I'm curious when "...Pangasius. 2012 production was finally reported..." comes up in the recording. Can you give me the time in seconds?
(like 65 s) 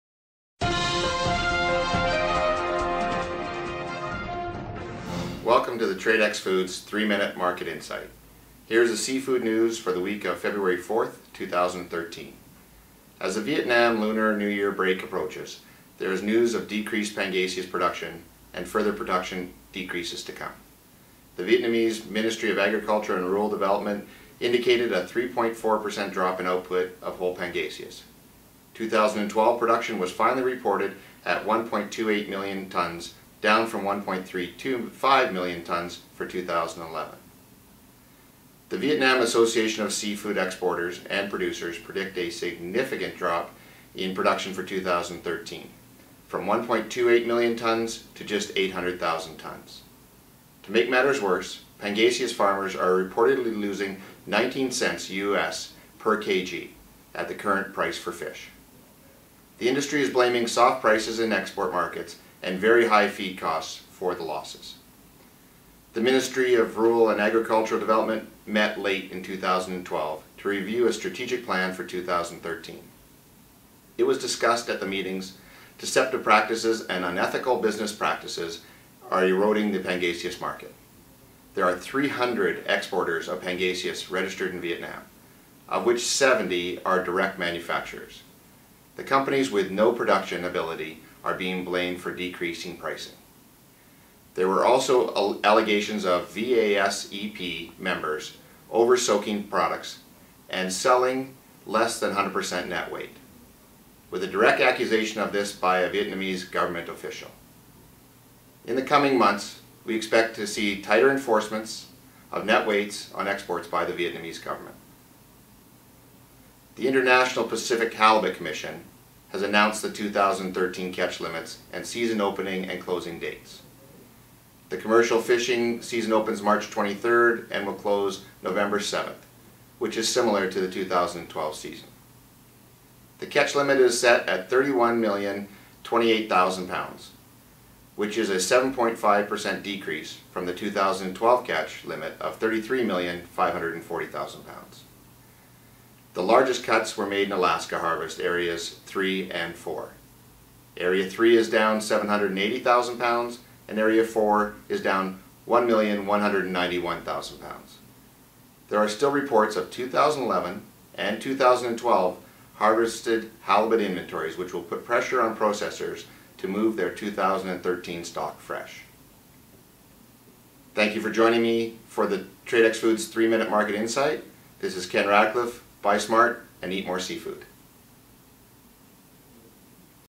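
27 s.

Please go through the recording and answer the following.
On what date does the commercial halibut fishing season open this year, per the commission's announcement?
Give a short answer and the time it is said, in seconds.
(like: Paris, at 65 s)
March 23rd, at 126 s.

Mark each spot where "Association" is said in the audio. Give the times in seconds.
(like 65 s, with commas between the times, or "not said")
39 s.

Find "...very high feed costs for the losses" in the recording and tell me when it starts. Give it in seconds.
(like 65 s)
62 s.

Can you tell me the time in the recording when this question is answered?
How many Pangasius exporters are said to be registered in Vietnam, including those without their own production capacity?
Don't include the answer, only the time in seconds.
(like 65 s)
81 s.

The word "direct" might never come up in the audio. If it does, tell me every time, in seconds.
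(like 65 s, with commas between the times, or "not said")
87 s, 104 s.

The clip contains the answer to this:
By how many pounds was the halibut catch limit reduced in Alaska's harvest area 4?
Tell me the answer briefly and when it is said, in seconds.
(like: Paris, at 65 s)
1,191,000 pounds, at 155 s.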